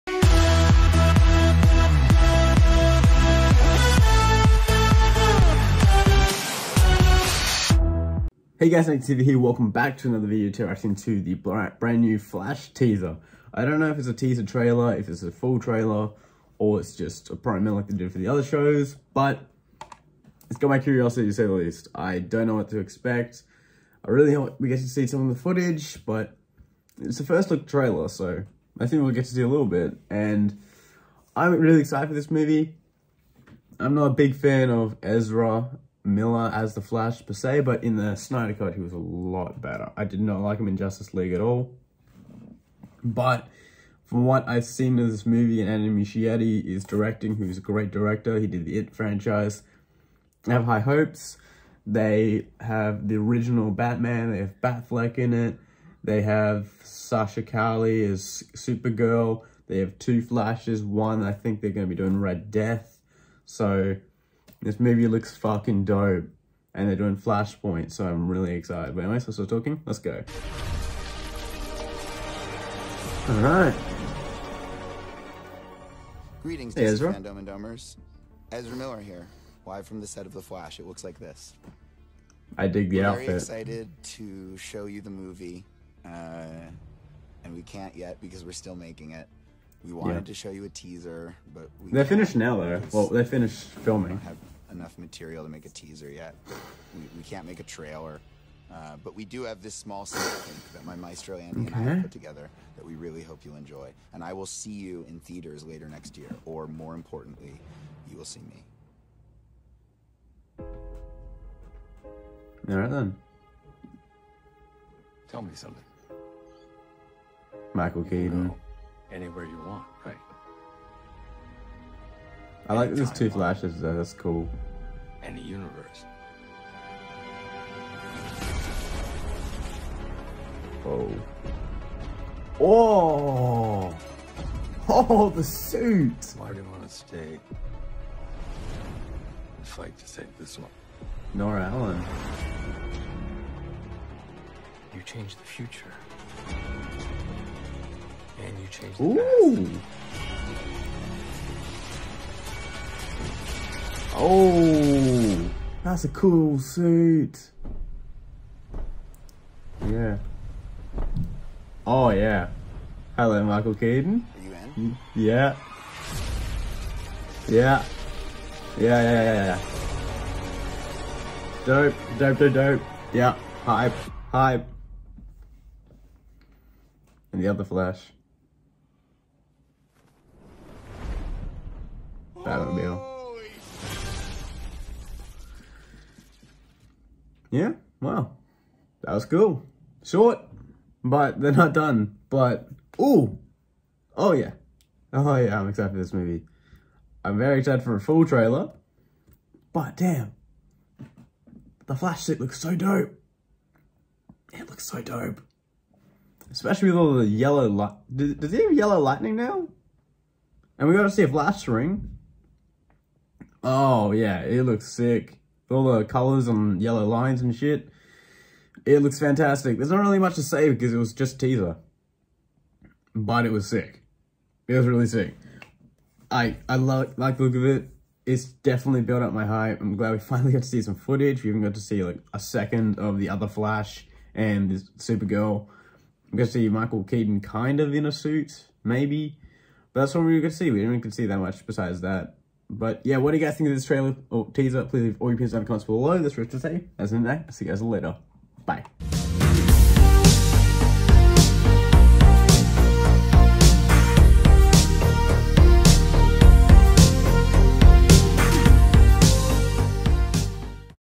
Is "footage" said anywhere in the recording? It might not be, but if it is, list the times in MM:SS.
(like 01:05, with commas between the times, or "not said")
00:25, 03:50.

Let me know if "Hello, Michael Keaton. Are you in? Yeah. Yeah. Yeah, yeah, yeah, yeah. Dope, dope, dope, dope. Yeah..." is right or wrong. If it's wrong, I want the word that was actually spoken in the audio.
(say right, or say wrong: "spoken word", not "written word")
right.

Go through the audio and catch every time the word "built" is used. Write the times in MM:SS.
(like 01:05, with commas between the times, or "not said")
03:49.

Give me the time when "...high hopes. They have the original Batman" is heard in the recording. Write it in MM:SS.
00:50.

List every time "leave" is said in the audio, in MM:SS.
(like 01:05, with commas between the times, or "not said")
04:05.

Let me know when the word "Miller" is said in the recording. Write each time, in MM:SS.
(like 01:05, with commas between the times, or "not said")
00:36, 01:18.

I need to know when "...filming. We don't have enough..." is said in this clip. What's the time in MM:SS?
01:33.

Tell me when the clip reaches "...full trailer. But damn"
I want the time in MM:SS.
03:18.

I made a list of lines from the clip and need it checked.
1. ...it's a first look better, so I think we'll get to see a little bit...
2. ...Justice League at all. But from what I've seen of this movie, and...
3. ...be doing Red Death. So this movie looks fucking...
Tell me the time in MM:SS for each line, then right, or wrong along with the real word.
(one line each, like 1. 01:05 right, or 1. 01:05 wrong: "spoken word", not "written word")
1. 00:27 wrong: "trailer", not "better"
2. 00:40 right
3. 01:01 right.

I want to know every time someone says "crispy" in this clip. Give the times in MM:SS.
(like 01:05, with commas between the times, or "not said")
not said.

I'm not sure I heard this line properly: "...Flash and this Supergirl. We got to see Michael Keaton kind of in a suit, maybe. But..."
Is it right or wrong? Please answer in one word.
right.